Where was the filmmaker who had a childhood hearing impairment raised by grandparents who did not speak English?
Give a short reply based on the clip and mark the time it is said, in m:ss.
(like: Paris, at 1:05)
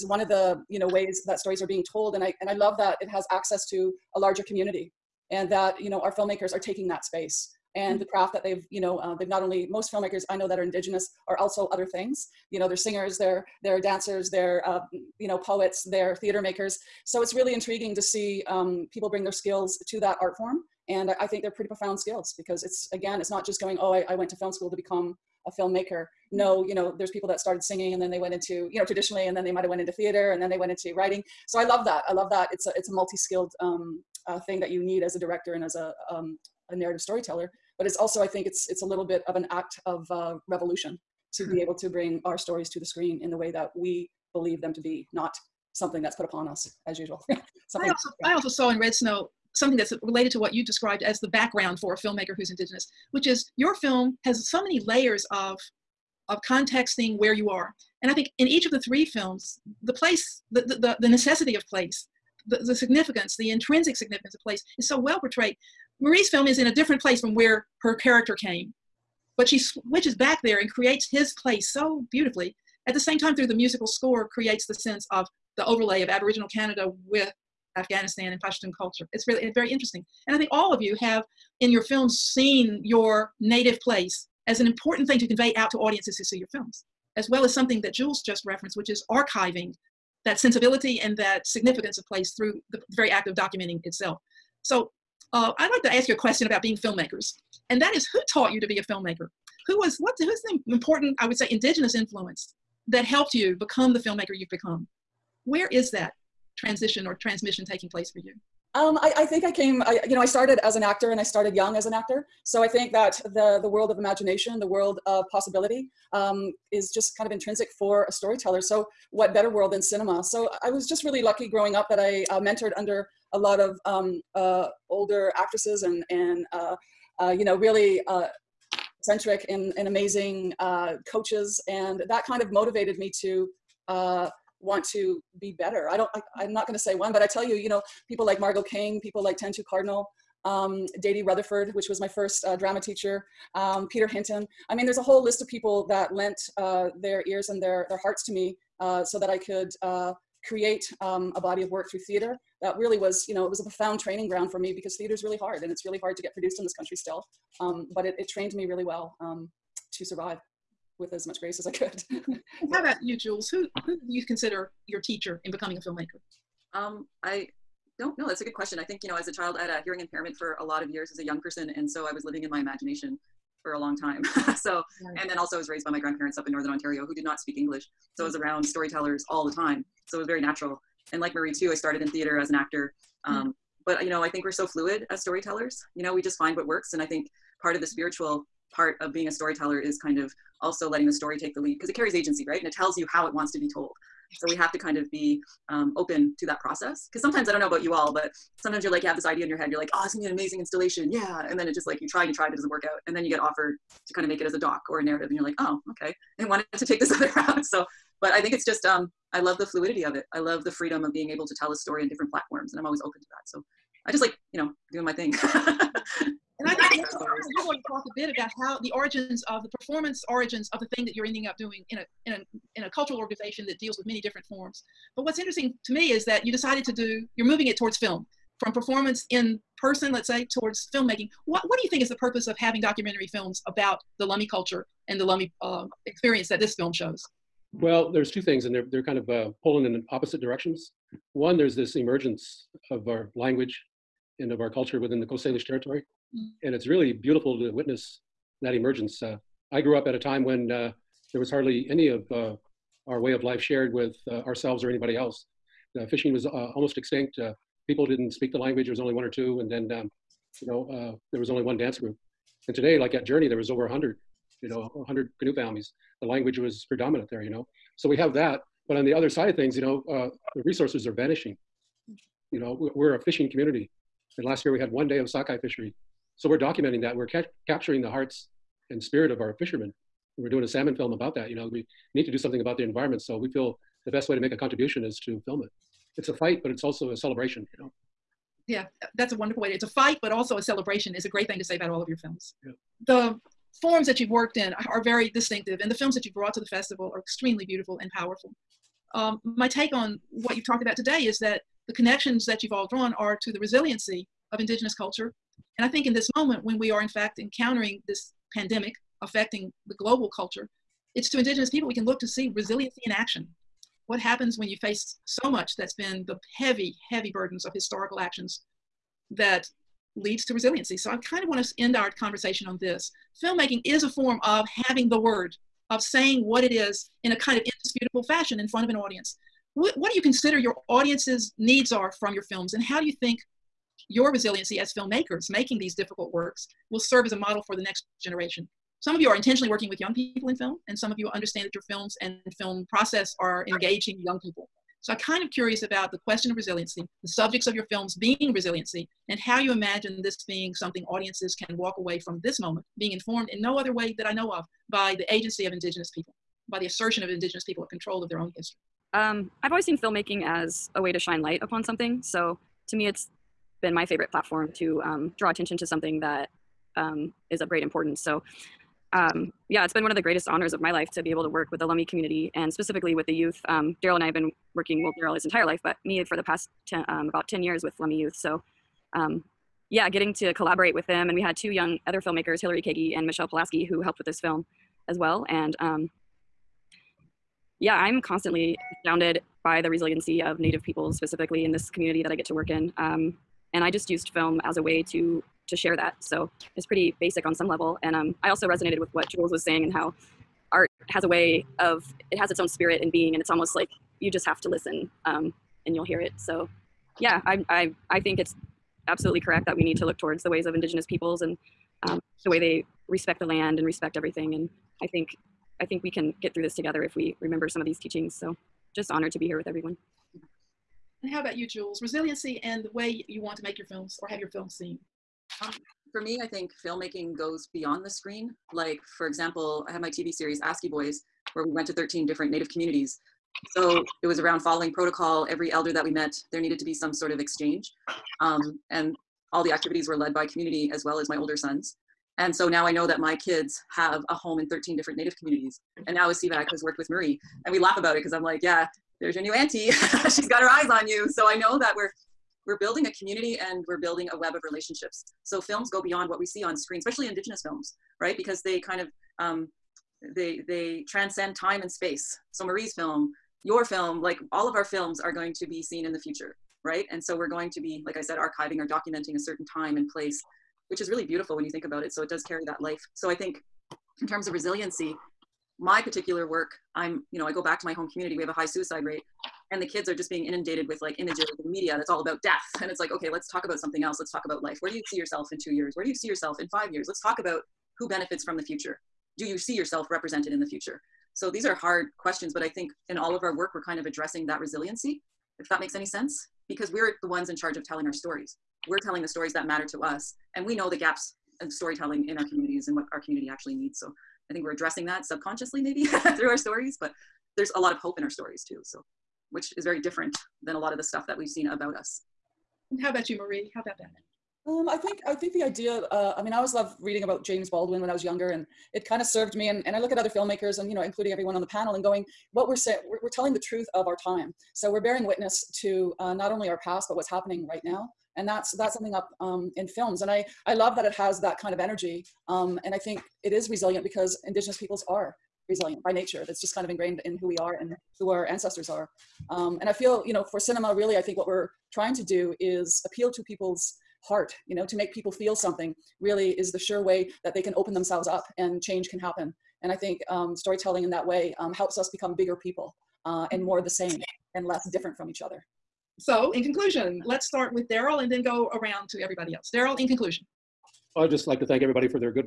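northern Ontario, at 2:56.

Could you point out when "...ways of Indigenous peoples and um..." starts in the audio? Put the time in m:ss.
6:50.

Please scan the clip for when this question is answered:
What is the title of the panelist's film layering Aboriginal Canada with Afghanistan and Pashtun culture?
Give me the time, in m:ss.
0:48.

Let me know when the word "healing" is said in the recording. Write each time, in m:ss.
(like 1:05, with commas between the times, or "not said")
not said.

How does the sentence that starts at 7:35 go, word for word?
So films go beyond what we see on screen, especially Indigenous films, right?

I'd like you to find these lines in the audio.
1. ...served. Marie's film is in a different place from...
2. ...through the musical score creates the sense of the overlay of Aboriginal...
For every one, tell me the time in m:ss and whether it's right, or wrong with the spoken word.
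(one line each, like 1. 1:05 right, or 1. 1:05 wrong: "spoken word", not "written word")
1. 1:05 wrong: "portrayed", not "served"
2. 1:13 right.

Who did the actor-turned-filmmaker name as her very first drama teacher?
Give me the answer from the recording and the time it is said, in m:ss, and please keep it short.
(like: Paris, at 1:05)
Dady Rutherford, at 2:21.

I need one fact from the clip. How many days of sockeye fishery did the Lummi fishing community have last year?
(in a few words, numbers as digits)
1.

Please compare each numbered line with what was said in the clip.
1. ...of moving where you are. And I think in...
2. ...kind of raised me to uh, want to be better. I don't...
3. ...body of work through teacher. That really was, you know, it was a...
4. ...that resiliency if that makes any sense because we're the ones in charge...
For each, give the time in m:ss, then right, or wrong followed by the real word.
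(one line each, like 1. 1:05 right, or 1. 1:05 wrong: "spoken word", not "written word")
1. 0:56 wrong: "contexting", not "moving"
2. 2:12 wrong: "motivated", not "raised"
3. 2:31 wrong: "theater", not "teacher"
4. 8:14 right.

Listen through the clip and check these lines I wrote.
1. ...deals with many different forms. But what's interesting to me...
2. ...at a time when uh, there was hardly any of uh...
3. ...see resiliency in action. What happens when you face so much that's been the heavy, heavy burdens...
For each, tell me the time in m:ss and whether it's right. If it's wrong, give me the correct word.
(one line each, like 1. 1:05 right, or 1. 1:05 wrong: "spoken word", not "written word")
1. 3:43 right
2. 4:10 right
3. 5:12 right.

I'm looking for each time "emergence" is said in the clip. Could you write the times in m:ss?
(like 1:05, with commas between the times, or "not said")
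4:01, 4:08.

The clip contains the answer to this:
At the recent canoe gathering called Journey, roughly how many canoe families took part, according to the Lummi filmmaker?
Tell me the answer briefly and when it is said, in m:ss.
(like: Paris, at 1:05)
over 100, at 4:23.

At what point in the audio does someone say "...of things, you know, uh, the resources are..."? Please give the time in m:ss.
4:29.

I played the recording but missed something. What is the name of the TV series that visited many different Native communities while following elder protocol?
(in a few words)
AskiBOYZ.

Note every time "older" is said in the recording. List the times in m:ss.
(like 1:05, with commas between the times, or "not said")
2:04, 7:21.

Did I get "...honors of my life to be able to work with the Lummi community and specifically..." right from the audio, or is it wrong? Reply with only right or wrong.
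right.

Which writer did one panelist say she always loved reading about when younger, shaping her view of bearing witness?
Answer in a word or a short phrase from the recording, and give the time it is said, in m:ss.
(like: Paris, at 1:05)
James Baldwin, at 8:37.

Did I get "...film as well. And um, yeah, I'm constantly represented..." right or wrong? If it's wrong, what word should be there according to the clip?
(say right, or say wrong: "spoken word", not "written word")
wrong: "astounded", not "represented".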